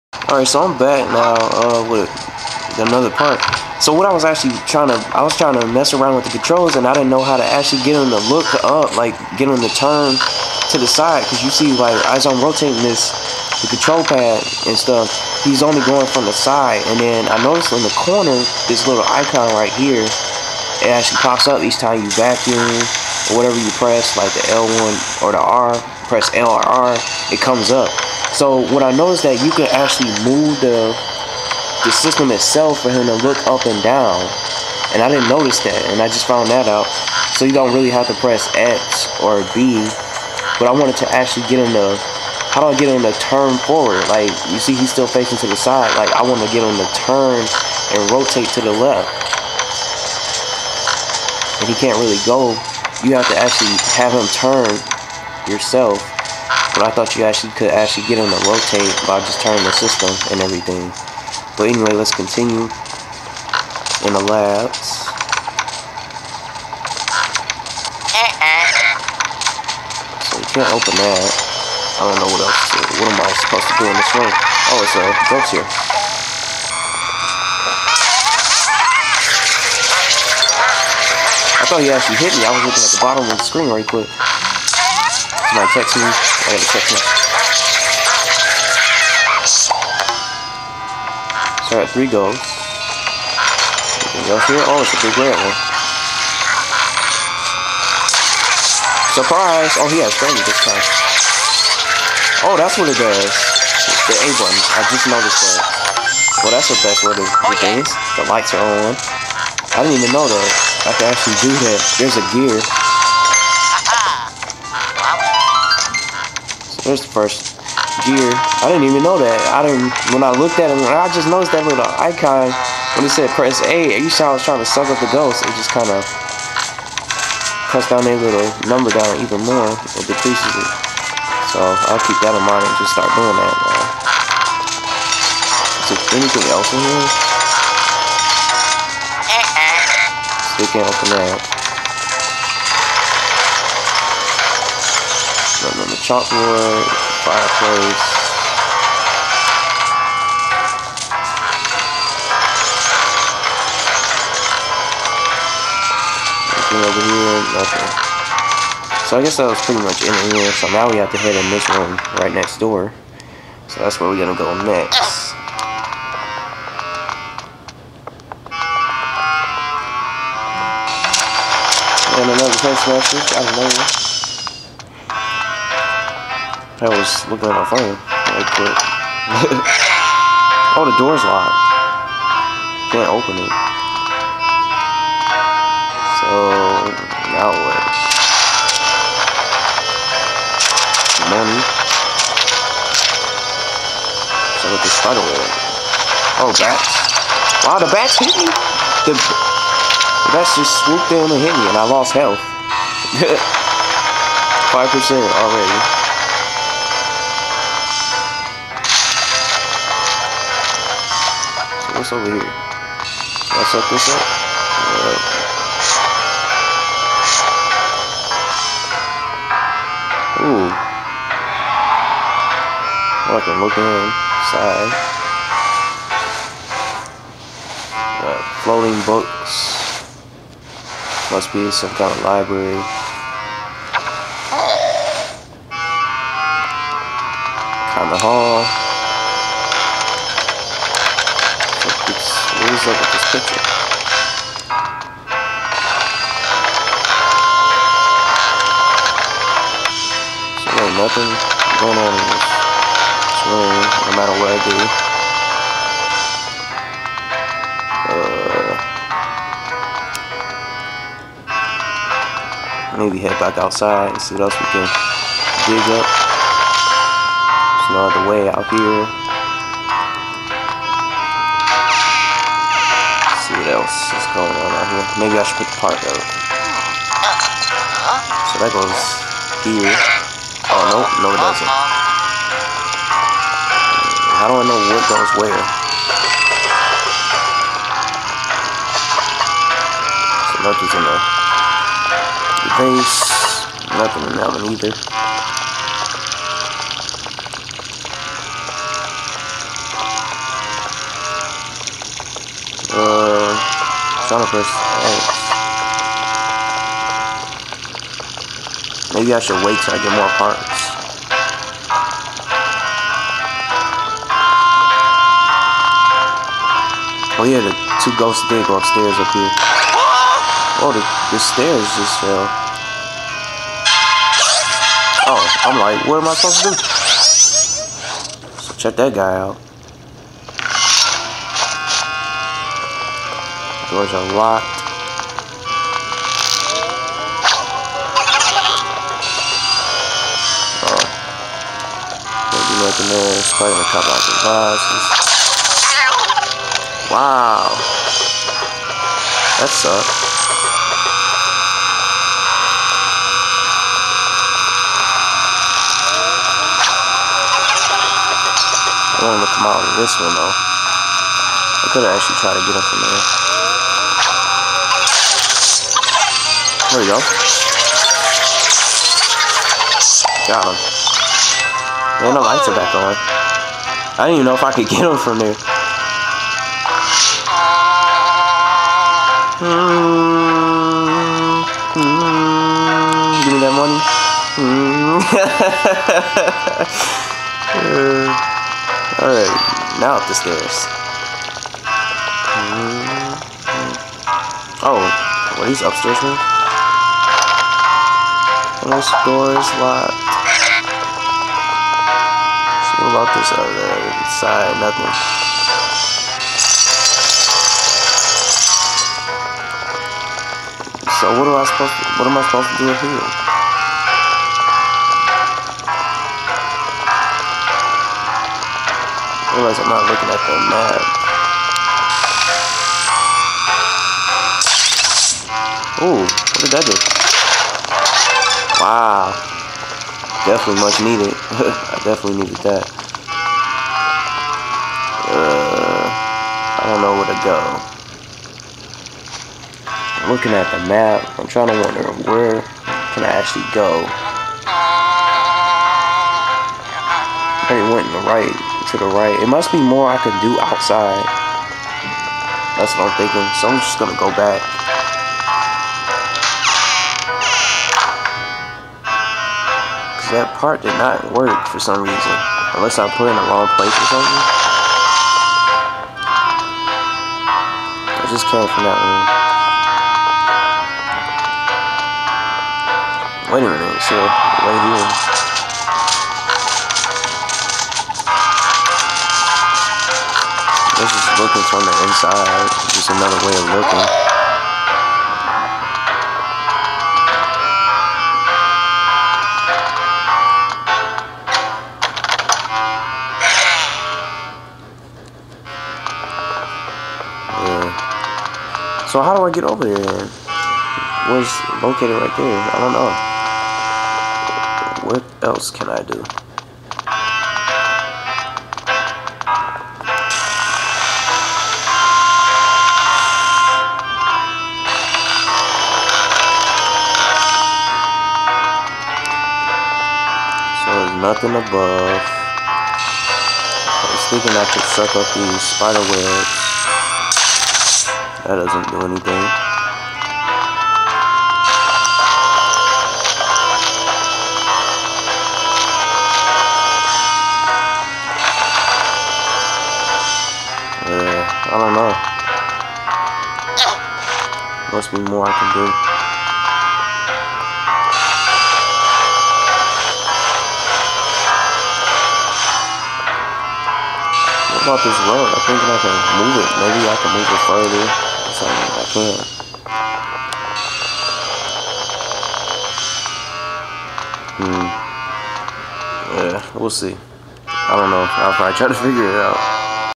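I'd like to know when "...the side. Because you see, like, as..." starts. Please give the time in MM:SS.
00:10.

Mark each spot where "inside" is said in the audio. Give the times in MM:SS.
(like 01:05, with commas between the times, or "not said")
03:43, 08:02.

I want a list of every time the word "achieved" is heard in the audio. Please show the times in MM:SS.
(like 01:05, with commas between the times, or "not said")
not said.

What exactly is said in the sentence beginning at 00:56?
But I thought you actually could actually get them to rotate by just turning the system and everything.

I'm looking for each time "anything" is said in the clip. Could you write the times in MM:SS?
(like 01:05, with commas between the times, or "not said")
01:34, 02:16, 02:36.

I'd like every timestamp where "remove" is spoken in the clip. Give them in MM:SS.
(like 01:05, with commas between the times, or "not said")
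not said.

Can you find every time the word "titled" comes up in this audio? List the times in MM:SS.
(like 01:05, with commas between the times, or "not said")
not said.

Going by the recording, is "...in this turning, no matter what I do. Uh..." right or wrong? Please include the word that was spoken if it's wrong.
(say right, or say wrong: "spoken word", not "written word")
wrong: "swing", not "turning".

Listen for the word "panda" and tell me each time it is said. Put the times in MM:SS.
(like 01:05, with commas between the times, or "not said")
not said.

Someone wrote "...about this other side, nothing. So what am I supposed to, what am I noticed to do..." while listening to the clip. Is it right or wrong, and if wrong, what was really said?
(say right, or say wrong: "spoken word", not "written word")
wrong: "supposed", not "noticed".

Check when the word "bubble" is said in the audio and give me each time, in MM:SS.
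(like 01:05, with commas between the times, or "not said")
not said.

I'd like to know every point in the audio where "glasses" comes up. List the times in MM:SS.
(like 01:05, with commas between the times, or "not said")
05:44.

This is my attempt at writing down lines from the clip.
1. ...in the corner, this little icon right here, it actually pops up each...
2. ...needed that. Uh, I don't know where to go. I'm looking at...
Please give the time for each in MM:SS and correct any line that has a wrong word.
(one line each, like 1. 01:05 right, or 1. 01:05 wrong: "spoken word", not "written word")
1. 00:17 right
2. 07:12 right.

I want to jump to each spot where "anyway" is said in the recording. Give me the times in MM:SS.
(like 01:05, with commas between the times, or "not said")
01:01.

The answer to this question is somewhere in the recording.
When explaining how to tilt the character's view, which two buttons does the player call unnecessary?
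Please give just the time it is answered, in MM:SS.
00:38.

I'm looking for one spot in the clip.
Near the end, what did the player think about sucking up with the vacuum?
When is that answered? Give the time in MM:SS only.
08:45.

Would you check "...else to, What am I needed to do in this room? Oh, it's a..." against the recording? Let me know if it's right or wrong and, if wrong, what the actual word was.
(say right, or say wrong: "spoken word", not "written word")
wrong: "supposed", not "needed".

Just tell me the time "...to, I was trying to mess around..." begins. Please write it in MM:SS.
00:04.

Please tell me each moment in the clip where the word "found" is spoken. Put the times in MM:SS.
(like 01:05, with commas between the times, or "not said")
00:36.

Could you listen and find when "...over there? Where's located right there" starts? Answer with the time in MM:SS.
08:19.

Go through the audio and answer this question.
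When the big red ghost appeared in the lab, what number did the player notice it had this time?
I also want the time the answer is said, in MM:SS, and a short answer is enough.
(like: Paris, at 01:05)
30, at 01:40.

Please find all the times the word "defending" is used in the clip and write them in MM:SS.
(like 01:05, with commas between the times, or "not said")
not said.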